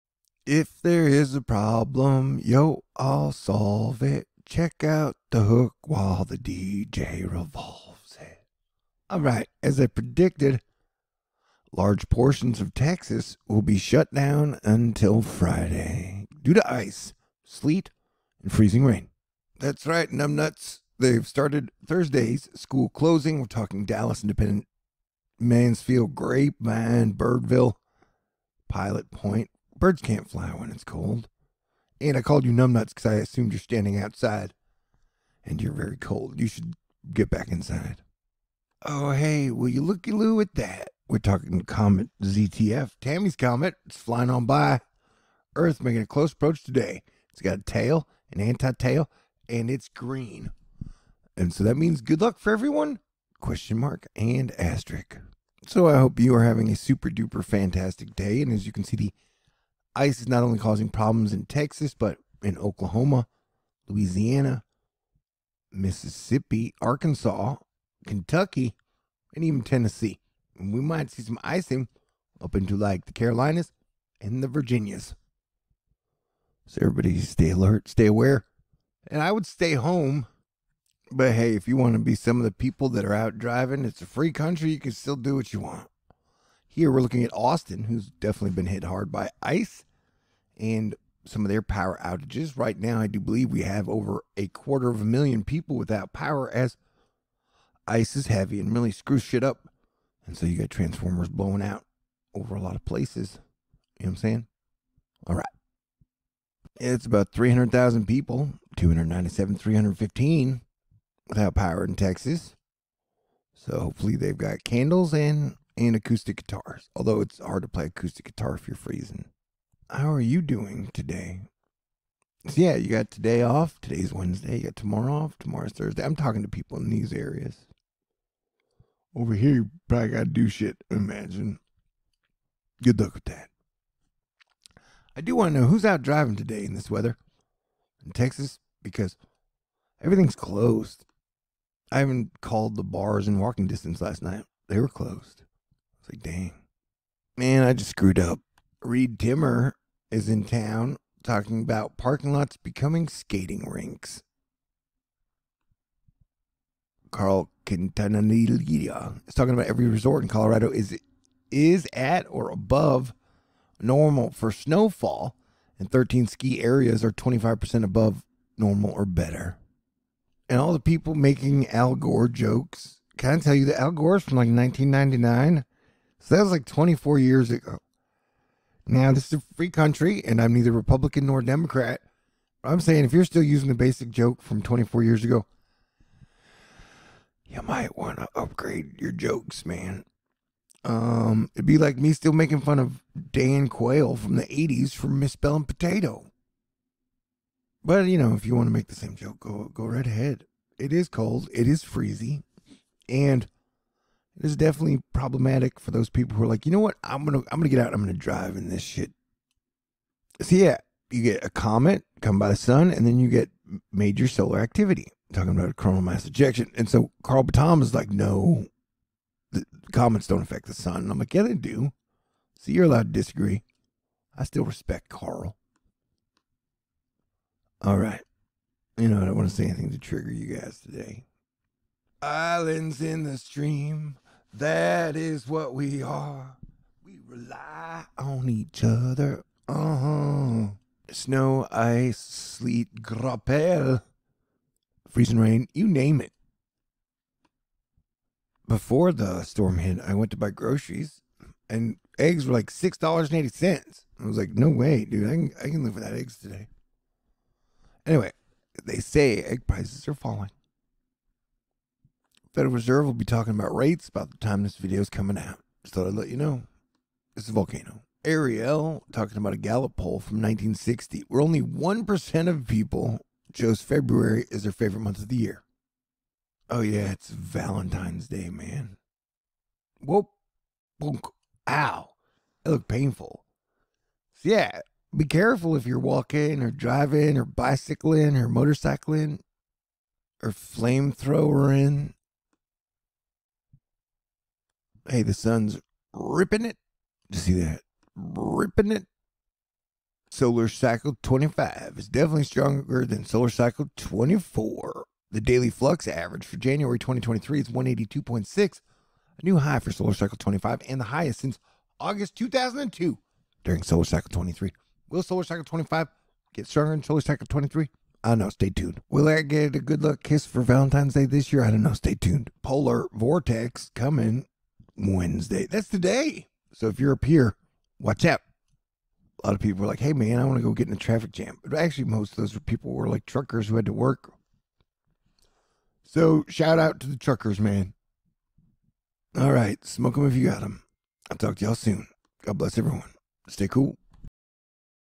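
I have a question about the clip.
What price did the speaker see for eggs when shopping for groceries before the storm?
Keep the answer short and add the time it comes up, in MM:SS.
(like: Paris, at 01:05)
$6.80, at 04:12.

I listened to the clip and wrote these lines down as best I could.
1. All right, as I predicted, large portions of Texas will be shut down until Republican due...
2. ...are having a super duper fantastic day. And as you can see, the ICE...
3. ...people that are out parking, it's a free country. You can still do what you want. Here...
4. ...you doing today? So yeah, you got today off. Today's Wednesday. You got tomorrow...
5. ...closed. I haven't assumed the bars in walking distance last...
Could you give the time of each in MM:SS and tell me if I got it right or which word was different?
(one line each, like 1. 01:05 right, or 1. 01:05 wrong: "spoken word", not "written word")
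1. 00:09 wrong: "Friday", not "Republican"
2. 00:56 right
3. 01:22 wrong: "driving", not "parking"
4. 02:00 right
5. 02:20 wrong: "called", not "assumed".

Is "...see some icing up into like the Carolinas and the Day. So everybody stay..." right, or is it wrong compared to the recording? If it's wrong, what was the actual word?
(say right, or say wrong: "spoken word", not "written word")
wrong: "Virginias", not "Day".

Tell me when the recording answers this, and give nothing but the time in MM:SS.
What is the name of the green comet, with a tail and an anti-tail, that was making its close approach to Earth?
00:41.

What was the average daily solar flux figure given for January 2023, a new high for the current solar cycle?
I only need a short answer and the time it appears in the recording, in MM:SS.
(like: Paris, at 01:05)
182.6, at 05:07.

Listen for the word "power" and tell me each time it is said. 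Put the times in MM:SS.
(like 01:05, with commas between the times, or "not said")
01:31, 01:36, 01:51.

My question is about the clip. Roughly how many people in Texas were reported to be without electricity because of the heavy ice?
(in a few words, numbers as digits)
297,315.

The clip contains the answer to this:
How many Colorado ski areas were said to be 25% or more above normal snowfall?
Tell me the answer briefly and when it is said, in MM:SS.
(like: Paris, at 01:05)
13, at 02:45.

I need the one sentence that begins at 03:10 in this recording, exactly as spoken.
Um, it'd be like me still making fun of Dan Quayle from the 80s for misspelling potato.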